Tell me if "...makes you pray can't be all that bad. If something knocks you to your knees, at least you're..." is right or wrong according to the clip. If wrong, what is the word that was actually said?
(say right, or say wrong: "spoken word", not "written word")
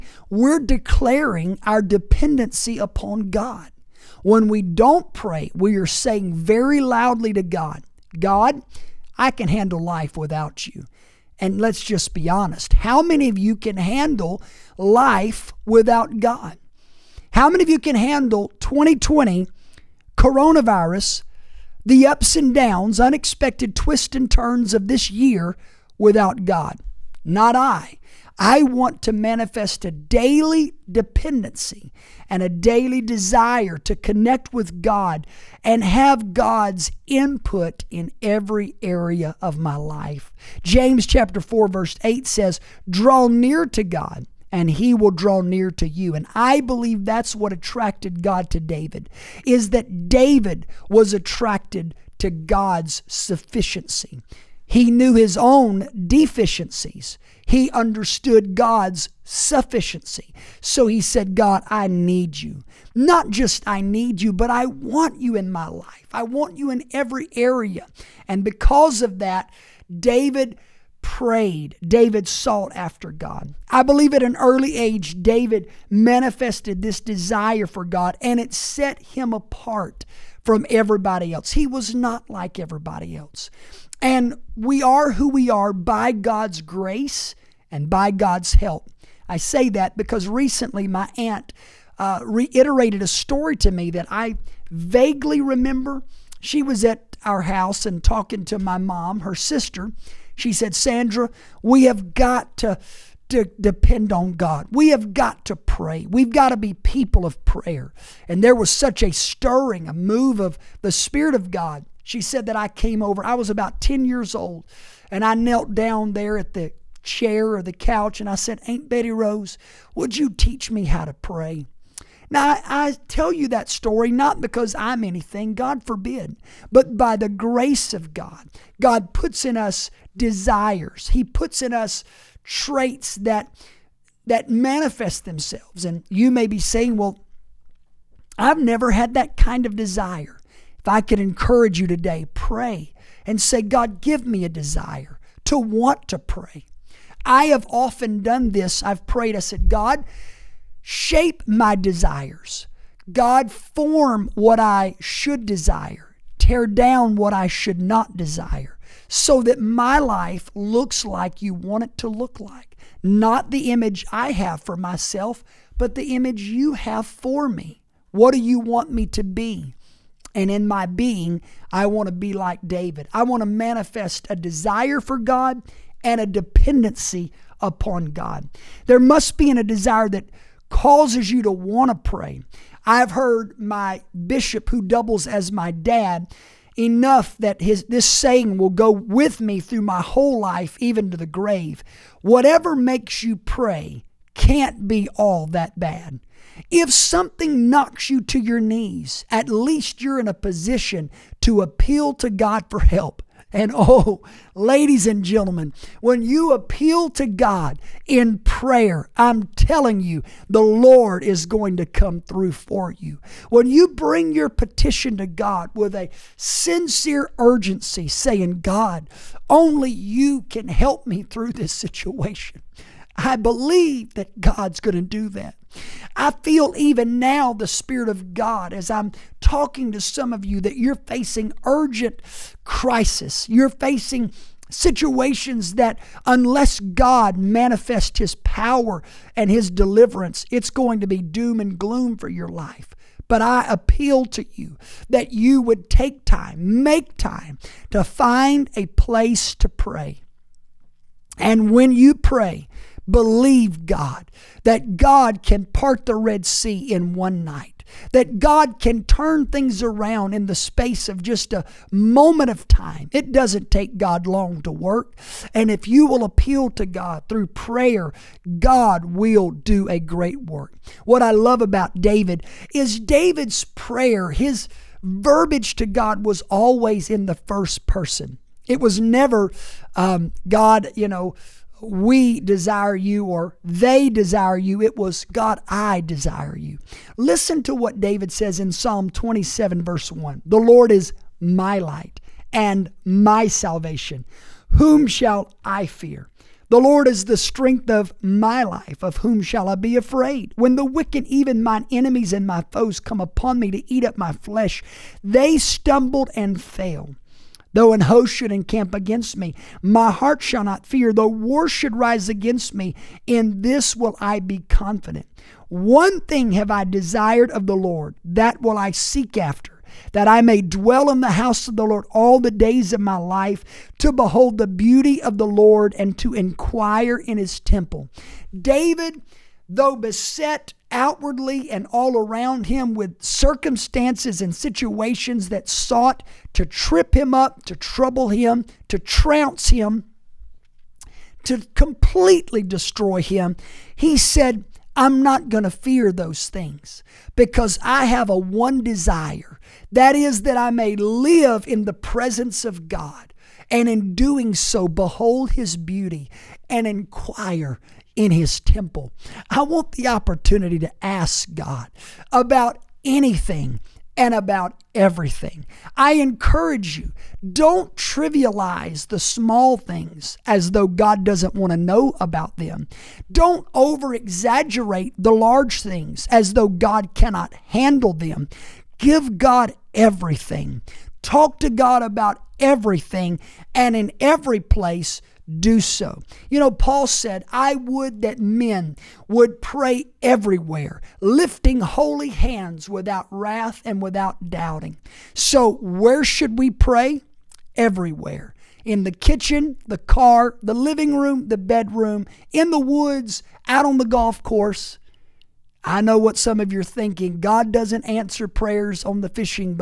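right.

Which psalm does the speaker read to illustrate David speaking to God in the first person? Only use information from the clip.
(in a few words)
Psalm 27.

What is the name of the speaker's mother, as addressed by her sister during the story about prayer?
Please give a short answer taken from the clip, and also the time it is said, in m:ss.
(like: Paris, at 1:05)
Sandra, at 1:40.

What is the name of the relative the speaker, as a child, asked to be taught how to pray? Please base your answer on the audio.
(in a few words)
Aunt Betty Rose.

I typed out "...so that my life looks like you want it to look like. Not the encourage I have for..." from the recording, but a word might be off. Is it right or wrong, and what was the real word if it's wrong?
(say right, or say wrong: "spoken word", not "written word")
wrong: "image", not "encourage".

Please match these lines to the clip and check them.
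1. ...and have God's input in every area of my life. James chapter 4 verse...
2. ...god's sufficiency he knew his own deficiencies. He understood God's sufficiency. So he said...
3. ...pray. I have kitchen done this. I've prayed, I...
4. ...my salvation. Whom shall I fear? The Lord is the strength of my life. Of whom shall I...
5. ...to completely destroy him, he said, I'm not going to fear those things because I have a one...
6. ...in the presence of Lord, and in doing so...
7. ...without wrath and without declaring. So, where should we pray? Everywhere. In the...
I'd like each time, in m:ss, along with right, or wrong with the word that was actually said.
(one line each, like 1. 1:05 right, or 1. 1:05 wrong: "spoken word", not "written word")
1. 0:35 right
2. 0:52 right
3. 2:26 wrong: "often", not "kitchen"
4. 4:53 right
5. 5:41 right
6. 5:51 wrong: "God", not "Lord"
7. 6:32 wrong: "doubting", not "declaring".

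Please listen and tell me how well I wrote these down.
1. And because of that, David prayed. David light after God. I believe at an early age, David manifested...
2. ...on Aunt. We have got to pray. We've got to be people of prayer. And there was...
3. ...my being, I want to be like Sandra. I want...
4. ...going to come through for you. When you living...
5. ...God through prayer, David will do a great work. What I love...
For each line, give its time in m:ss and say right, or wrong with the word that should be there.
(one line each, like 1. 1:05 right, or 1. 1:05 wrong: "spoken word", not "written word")
1. 1:08 wrong: "sought", not "light"
2. 1:44 wrong: "God", not "Aunt"
3. 2:50 wrong: "David", not "Sandra"
4. 3:31 wrong: "bring", not "living"
5. 4:26 wrong: "God", not "David".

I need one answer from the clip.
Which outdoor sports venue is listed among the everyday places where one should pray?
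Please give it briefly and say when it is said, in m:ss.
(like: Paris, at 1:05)
golf course, at 6:44.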